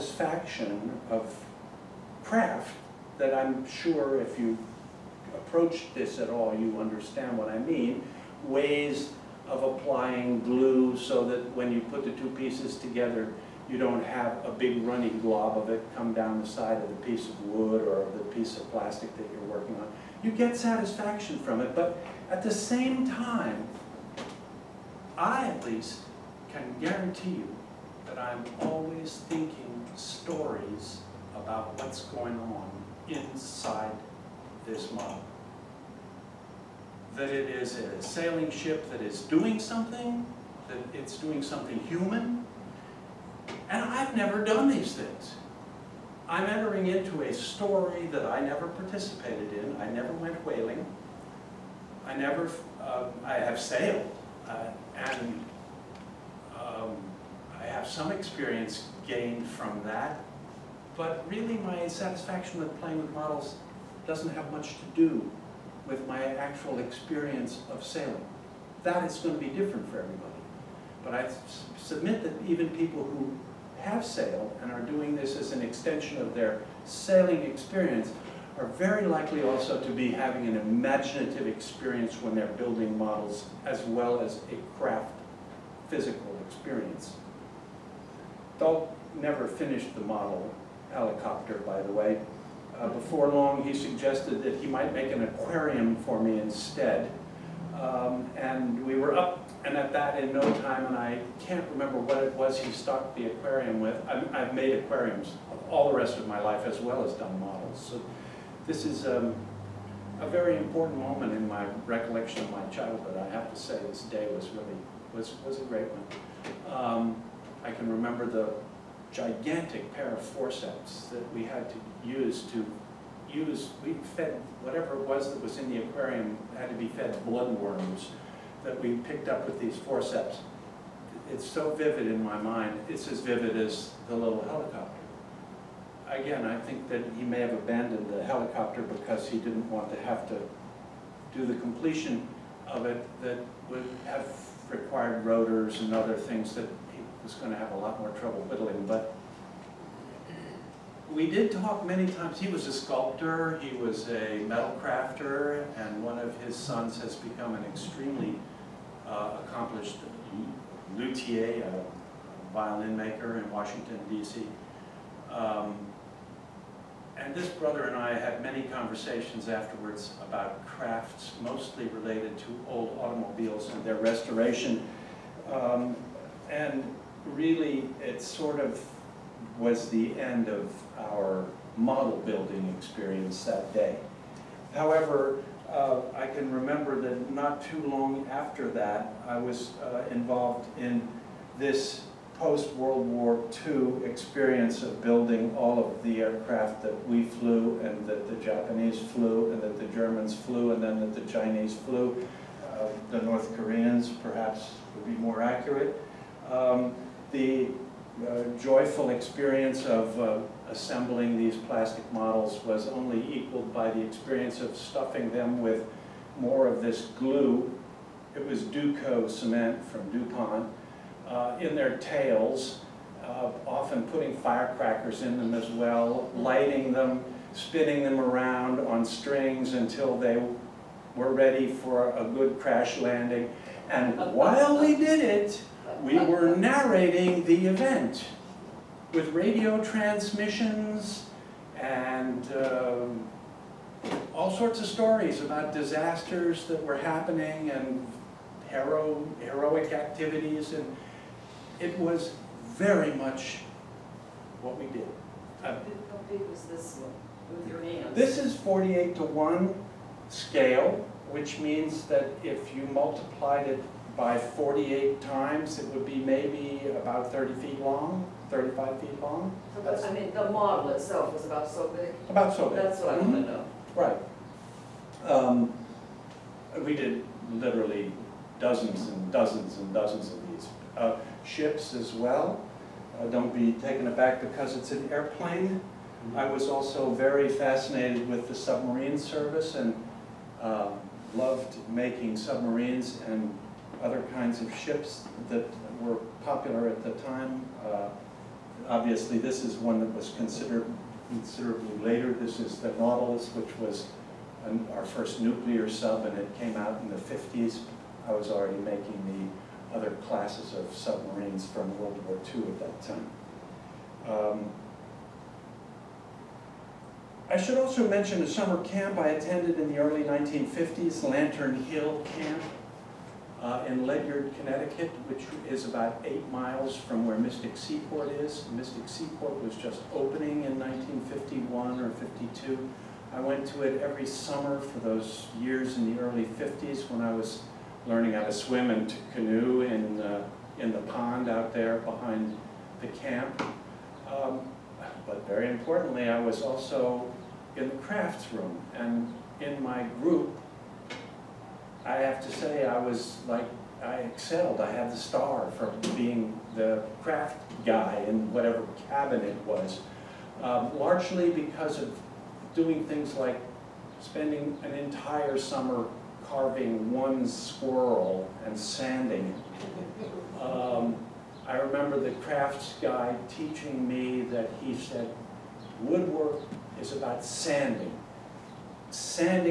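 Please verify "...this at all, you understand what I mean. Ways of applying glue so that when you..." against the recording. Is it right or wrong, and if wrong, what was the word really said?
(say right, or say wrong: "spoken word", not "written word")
right.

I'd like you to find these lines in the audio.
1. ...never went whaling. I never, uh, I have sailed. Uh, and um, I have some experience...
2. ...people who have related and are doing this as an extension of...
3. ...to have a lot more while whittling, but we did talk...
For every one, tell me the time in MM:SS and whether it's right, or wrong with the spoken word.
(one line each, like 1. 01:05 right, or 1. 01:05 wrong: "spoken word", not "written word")
1. 00:49 right
2. 01:12 wrong: "sailed", not "related"
3. 02:27 wrong: "trouble", not "while".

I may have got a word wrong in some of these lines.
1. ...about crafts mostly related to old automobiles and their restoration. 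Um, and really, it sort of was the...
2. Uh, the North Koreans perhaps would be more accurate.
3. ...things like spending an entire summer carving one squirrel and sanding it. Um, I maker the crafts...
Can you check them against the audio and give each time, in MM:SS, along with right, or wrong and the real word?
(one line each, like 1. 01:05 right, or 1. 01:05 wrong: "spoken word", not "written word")
1. 02:50 right
2. 03:22 right
3. 06:03 wrong: "remember", not "maker".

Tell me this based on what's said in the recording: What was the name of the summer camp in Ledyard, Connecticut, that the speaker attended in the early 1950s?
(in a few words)
Lantern Hill Camp.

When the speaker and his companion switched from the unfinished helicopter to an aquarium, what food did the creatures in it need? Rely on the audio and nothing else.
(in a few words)
bloodworms.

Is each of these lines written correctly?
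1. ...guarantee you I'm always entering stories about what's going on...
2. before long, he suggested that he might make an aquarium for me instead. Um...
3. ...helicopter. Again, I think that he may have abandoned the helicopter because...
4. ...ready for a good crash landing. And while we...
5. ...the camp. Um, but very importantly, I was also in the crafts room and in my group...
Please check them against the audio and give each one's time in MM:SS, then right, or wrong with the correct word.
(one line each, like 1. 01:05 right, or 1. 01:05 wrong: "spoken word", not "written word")
1. 00:26 wrong: "thinking", not "entering"
2. 01:32 right
3. 02:14 right
4. 03:51 right
5. 05:43 right.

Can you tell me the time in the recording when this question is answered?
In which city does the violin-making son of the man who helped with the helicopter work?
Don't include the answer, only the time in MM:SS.
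02:43.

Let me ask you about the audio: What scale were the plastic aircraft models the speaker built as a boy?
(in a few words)
48 to 1.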